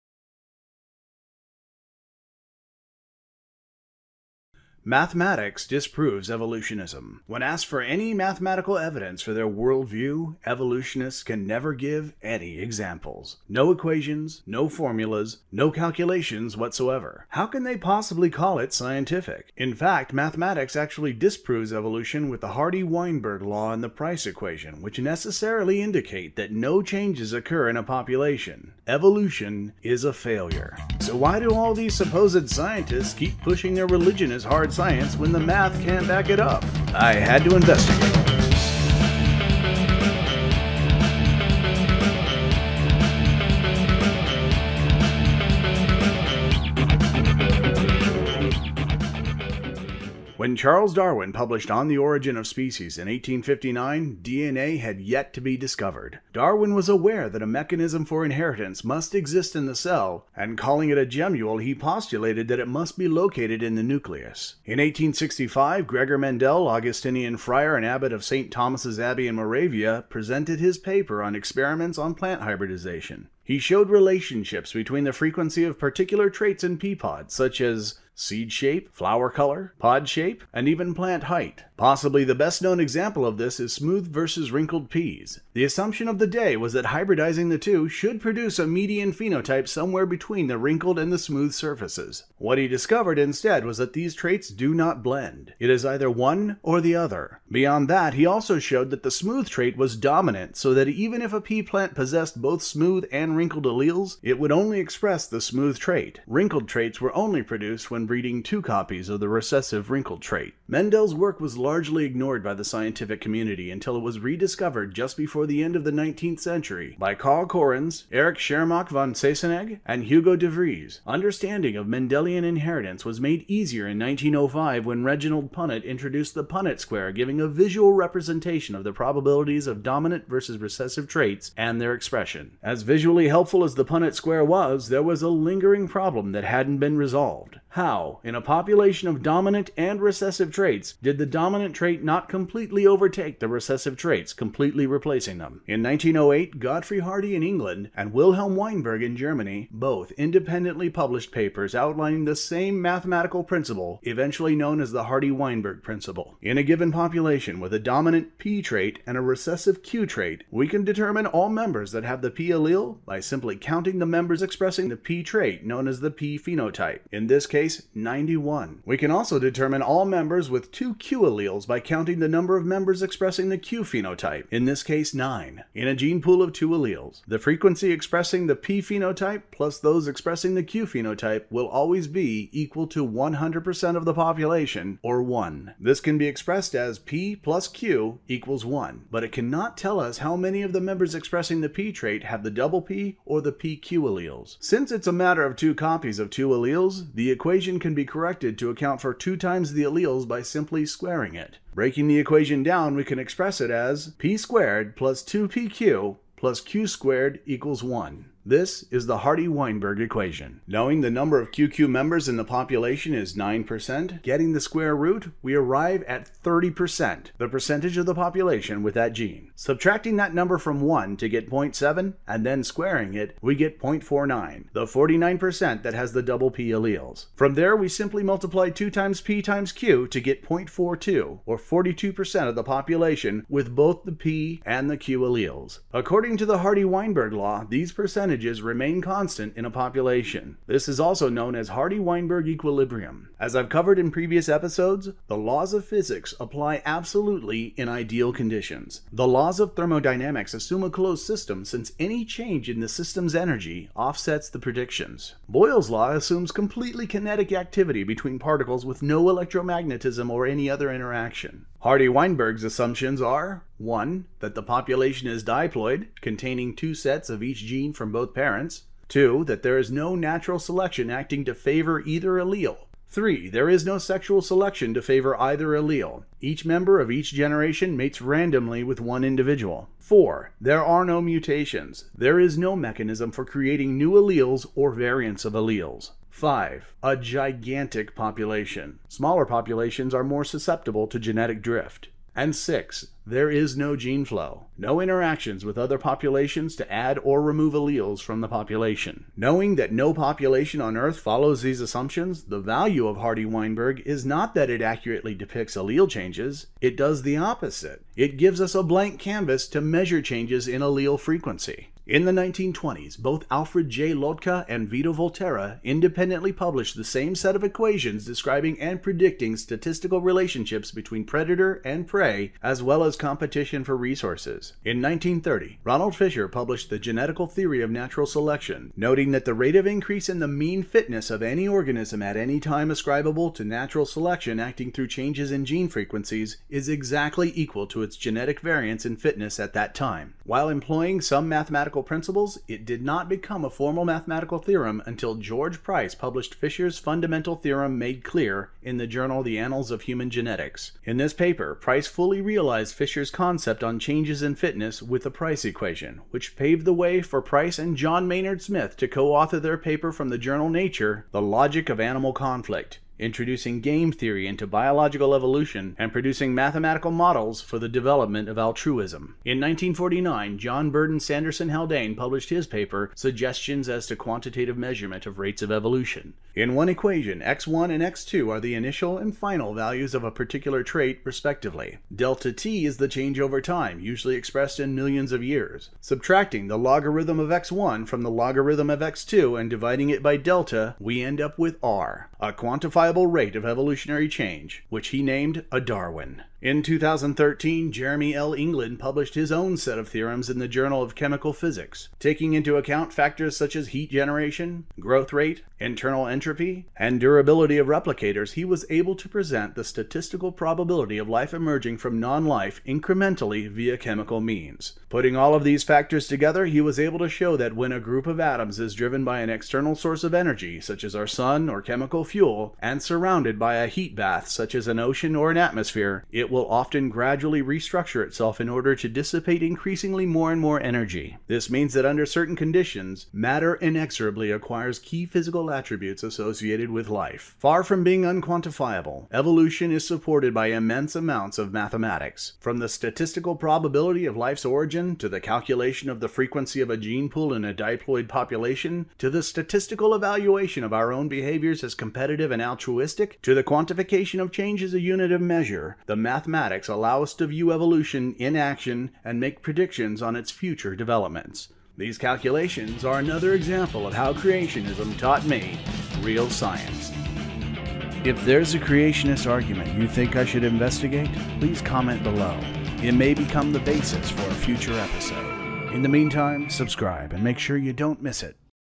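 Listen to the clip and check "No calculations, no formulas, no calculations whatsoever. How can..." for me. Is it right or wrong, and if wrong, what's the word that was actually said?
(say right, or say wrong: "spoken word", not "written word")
wrong: "equations", not "calculations".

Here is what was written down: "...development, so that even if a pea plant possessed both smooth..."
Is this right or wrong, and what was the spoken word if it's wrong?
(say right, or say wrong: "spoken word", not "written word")
wrong: "dominant", not "development".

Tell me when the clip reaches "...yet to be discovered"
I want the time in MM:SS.
00:54.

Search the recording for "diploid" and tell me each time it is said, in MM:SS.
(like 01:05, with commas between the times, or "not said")
04:25, 07:27.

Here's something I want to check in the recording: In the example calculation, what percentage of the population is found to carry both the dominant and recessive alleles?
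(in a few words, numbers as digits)
42%.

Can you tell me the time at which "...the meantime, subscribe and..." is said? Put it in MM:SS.
07:56.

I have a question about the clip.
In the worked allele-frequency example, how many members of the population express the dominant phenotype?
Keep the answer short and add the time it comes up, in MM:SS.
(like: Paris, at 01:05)
91, at 02:47.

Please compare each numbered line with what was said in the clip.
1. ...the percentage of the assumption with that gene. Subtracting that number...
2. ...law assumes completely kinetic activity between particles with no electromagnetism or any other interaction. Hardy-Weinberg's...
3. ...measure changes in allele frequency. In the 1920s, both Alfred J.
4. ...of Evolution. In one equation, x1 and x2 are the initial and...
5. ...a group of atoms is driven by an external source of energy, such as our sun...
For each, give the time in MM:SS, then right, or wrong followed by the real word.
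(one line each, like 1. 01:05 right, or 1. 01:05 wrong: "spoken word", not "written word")
1. 03:37 wrong: "population", not "assumption"
2. 04:15 right
3. 05:09 right
4. 06:15 right
5. 06:57 right.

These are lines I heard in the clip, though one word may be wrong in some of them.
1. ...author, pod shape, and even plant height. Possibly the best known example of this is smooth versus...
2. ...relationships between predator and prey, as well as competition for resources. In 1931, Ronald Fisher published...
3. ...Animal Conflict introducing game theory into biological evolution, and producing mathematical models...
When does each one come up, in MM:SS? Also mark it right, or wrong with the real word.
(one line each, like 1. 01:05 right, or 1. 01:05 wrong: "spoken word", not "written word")
1. 01:19 wrong: "color", not "author"
2. 05:20 wrong: "1930", not "1931"
3. 06:01 right.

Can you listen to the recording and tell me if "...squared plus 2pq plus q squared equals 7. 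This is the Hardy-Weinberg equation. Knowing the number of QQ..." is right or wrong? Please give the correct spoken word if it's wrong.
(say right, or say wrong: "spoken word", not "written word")
wrong: "1", not "7".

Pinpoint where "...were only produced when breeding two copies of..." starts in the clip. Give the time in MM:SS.
01:47.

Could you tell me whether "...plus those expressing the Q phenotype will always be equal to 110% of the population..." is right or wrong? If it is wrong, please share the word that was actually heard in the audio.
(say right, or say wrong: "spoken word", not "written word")
wrong: "100", not "110".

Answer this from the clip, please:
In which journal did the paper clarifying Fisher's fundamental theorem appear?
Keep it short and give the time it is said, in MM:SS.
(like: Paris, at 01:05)
The Annals of Human Genetics, at 05:49.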